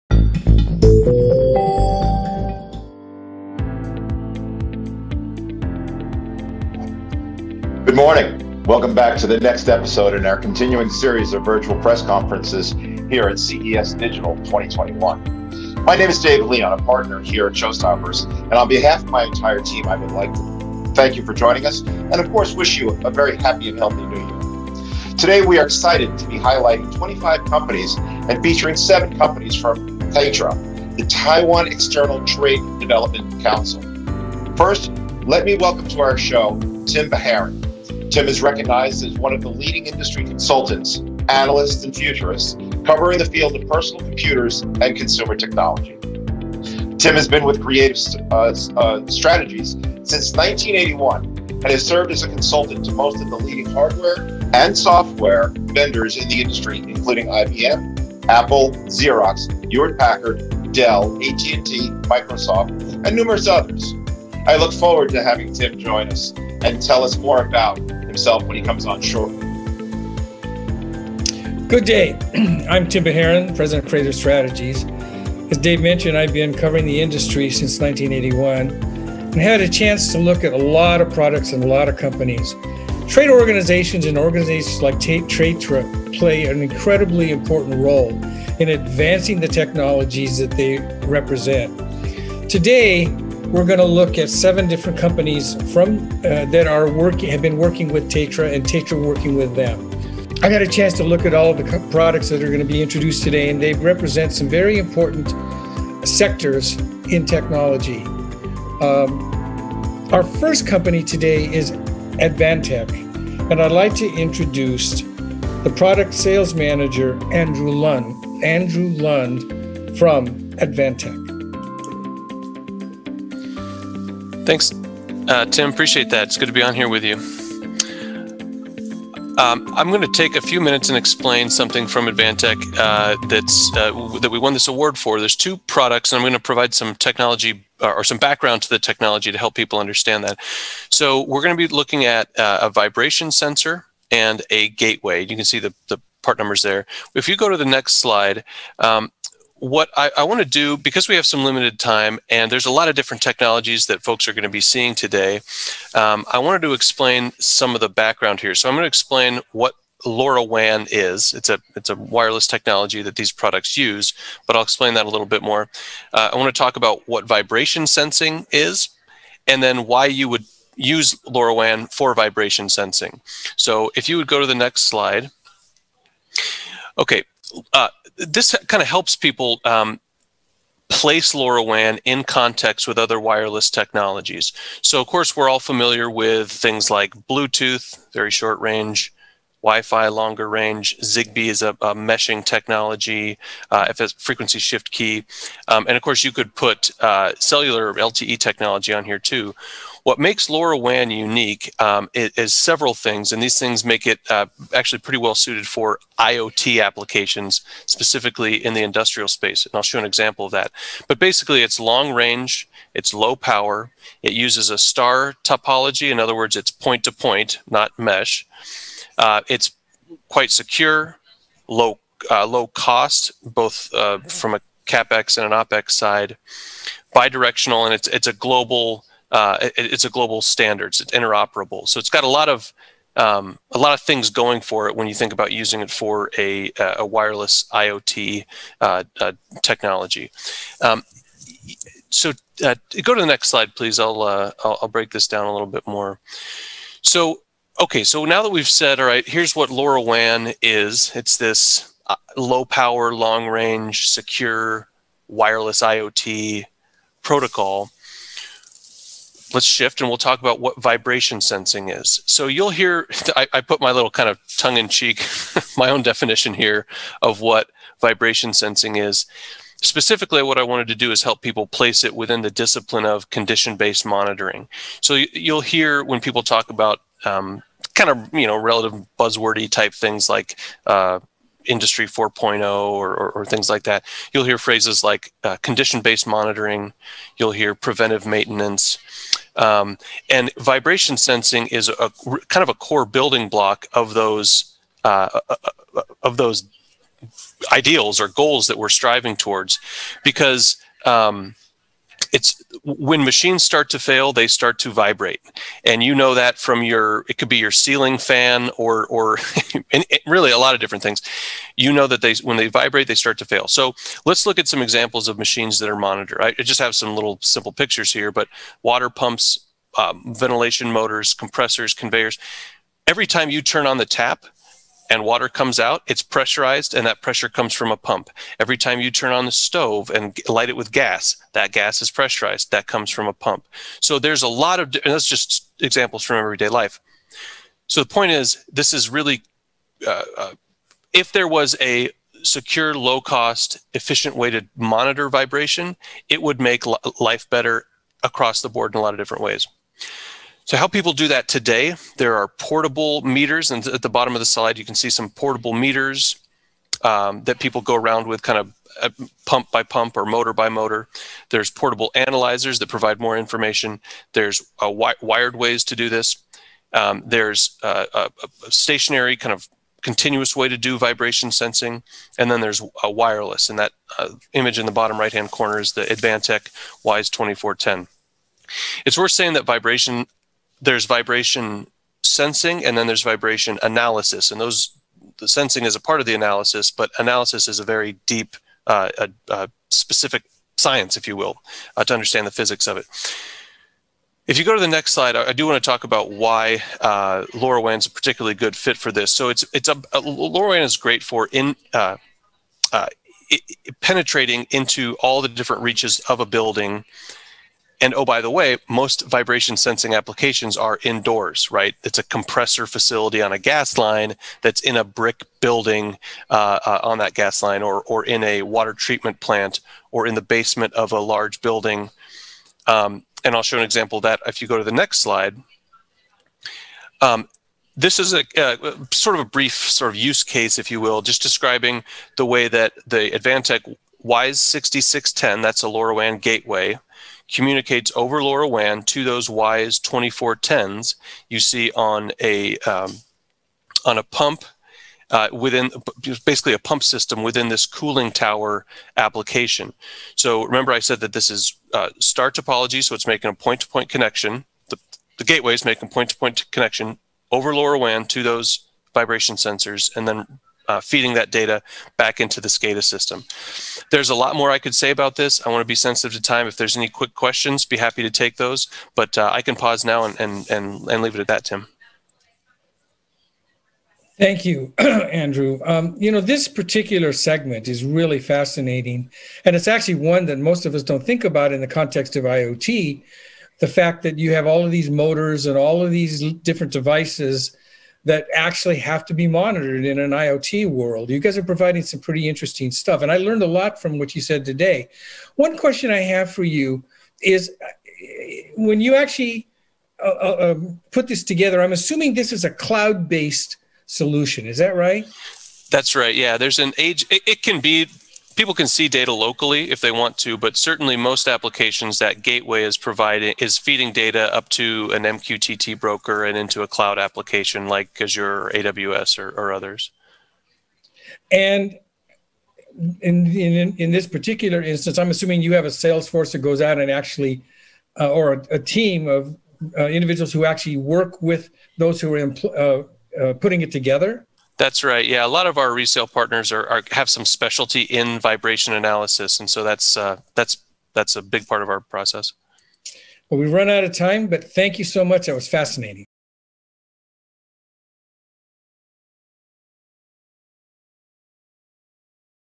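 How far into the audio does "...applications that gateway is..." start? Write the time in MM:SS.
08:31.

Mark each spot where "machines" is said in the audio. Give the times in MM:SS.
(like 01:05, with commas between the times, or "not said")
05:03, 05:15.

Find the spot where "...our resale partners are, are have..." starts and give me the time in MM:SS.
08:55.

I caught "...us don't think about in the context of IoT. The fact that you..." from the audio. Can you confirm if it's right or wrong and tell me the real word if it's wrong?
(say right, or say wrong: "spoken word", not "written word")
right.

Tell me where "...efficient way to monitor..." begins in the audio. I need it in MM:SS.
05:43.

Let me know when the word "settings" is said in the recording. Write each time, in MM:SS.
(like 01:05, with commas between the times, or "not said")
not said.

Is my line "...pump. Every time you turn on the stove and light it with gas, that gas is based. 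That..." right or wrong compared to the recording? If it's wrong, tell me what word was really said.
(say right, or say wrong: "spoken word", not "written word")
wrong: "pressurized", not "based".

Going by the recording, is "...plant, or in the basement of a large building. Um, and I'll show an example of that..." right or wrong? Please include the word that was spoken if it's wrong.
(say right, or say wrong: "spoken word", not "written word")
right.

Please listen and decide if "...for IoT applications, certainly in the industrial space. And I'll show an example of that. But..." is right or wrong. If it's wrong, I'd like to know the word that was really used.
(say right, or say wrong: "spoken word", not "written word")
wrong: "specifically", not "certainly".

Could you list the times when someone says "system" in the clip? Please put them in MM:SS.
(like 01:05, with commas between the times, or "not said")
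07:27, 07:43.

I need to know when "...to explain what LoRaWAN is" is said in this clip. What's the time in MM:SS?
02:38.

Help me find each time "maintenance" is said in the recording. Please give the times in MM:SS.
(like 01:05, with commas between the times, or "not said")
04:48.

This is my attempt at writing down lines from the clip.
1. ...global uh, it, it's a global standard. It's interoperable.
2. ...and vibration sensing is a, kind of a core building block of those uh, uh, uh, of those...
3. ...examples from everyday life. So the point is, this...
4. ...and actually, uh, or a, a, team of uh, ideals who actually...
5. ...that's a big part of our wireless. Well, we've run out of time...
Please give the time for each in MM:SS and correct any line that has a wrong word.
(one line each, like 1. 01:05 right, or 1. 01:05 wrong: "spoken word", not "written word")
1. 03:48 right
2. 04:50 right
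3. 05:35 right
4. 08:46 wrong: "individuals", not "ideals"
5. 09:01 wrong: "process", not "wireless".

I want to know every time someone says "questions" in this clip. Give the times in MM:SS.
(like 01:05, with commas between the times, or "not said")
07:47, 08:15.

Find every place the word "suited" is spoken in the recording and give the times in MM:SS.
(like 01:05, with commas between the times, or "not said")
03:25.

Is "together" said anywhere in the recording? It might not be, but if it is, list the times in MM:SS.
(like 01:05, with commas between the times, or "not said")
08:21, 08:53.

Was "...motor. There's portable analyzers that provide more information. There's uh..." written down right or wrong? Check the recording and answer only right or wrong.
right.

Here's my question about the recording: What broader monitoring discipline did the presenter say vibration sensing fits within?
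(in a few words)
condition-based monitoring.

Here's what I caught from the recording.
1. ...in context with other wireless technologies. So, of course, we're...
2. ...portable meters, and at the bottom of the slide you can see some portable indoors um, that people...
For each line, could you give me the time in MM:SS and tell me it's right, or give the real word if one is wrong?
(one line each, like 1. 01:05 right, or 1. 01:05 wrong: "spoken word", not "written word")
1. 03:02 right
2. 05:52 wrong: "meters", not "indoors".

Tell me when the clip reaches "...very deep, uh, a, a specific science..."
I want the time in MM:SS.
06:27.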